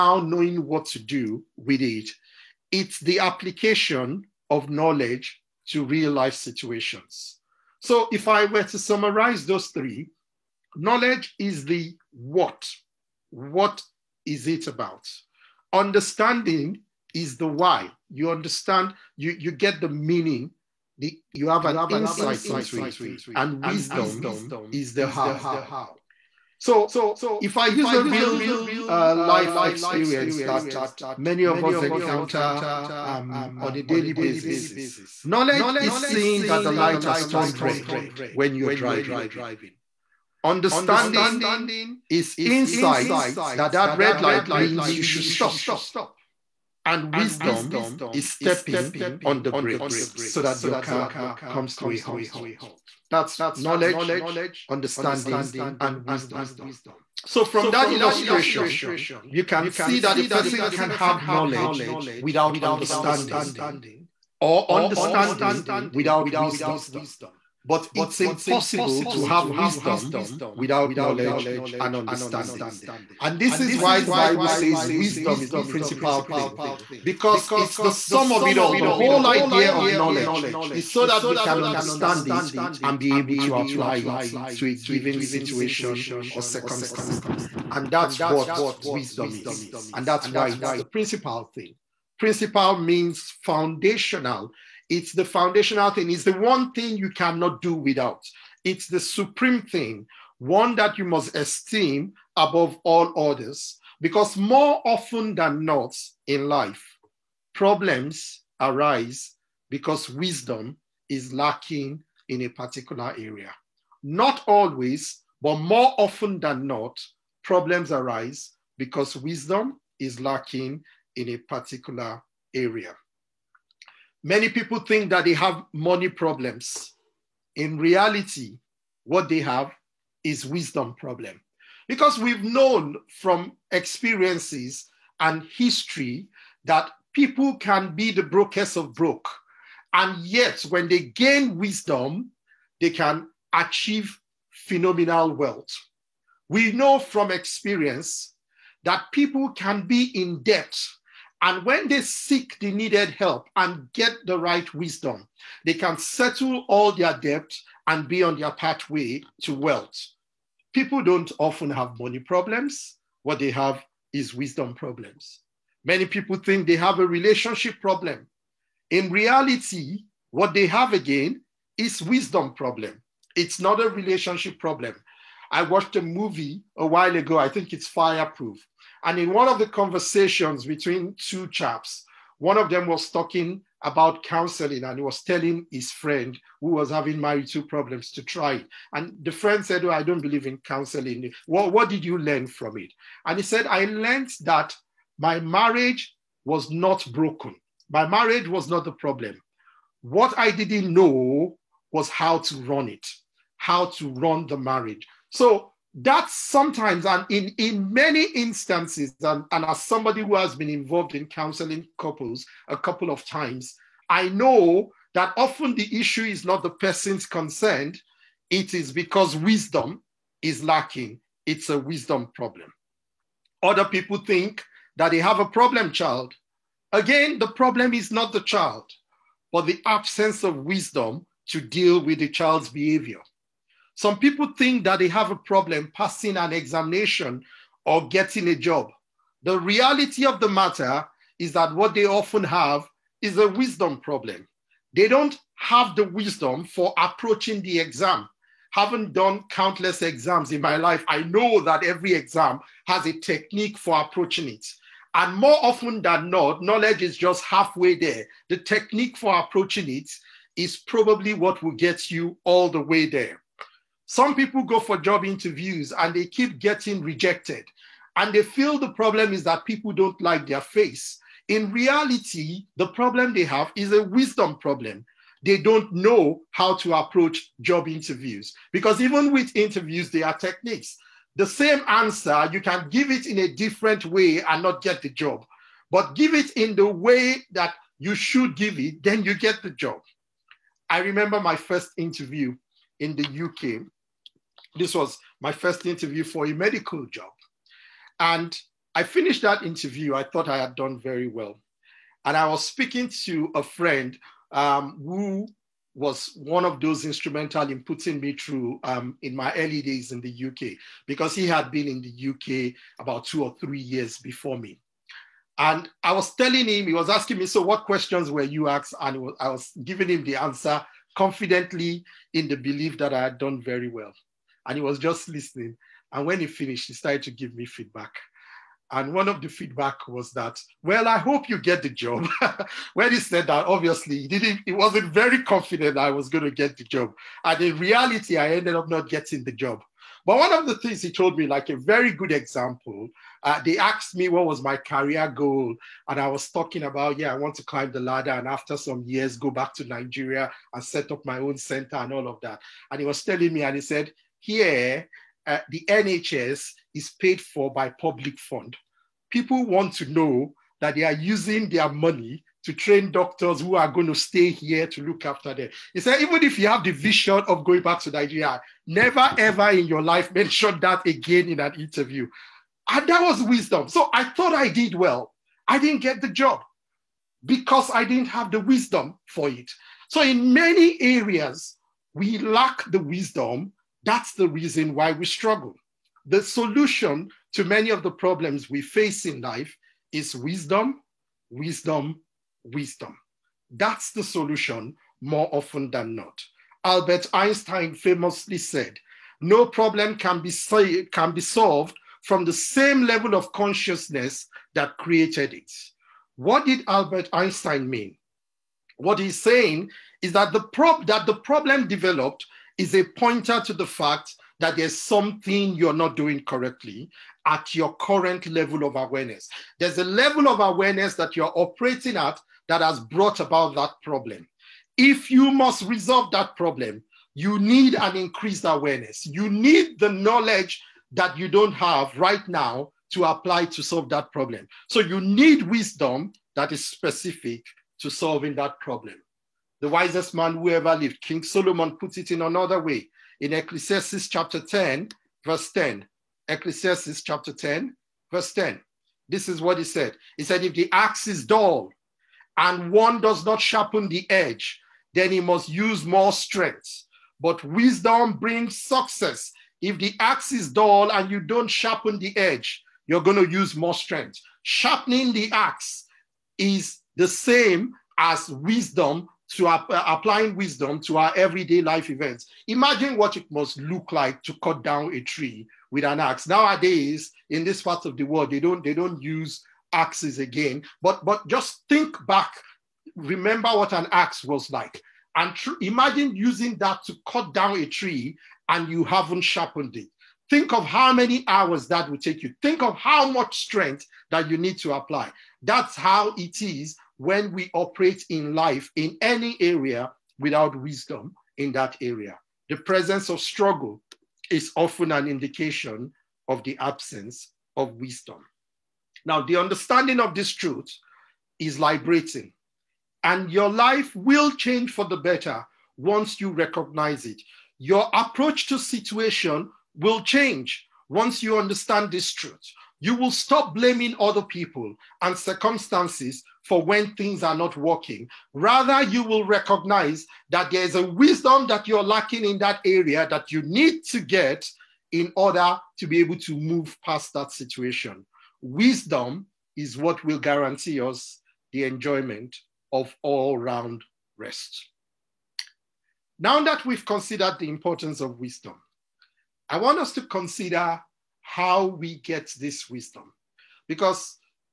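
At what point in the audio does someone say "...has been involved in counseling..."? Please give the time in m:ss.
3:30.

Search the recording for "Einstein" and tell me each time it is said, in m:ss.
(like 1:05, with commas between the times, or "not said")
6:37, 6:47.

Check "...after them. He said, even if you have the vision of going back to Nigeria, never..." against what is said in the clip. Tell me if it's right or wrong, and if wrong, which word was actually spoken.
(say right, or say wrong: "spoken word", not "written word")
right.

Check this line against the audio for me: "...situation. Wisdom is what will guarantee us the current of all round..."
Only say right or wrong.
wrong.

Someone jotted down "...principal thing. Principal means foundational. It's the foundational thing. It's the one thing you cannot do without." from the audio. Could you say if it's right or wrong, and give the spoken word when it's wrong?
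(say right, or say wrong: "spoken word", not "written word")
right.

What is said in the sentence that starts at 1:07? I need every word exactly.
But it's impossible to have wisdom without knowledge and understanding.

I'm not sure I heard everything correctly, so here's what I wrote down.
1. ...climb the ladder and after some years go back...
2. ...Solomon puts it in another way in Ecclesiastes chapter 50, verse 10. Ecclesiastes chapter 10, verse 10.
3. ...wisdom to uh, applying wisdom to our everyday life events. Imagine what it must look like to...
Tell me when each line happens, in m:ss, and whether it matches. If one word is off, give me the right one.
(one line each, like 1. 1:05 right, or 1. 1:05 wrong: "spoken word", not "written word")
1. 5:47 right
2. 7:21 wrong: "10", not "50"
3. 7:48 right.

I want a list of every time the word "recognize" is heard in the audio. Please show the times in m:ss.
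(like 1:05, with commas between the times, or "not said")
8:36, 8:49.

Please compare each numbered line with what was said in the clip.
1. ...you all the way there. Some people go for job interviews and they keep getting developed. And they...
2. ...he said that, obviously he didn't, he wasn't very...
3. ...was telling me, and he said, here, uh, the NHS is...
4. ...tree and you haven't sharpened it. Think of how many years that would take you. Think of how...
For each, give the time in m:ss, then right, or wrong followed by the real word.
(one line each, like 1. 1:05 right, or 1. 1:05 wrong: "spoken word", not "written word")
1. 4:22 wrong: "rejected", not "developed"
2. 5:33 right
3. 5:53 right
4. 8:07 wrong: "hours", not "years".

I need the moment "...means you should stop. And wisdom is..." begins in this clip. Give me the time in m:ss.
0:44.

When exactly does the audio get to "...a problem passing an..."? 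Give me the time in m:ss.
3:55.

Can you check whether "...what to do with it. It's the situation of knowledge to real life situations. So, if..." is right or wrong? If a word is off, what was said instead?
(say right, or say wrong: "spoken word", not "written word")
wrong: "application", not "situation".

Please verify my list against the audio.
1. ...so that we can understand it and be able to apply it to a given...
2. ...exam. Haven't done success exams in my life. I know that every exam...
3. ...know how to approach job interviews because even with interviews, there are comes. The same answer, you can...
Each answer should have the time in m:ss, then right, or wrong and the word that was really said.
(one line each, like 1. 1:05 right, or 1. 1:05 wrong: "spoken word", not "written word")
1. 1:20 right
2. 4:07 wrong: "countless", not "success"
3. 4:35 wrong: "techniques", not "comes".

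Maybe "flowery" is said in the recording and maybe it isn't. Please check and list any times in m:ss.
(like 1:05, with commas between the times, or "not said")
not said.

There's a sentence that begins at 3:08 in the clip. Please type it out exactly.
And the friend said, Oh, I don't believe in counseling.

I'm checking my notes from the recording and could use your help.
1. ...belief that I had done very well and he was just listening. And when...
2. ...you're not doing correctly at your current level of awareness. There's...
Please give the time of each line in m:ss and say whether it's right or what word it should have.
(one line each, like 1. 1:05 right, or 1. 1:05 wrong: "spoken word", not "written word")
1. 5:22 right
2. 6:55 right.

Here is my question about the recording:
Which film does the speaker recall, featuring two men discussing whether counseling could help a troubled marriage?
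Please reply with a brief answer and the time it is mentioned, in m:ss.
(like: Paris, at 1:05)
Fireproof, at 2:57.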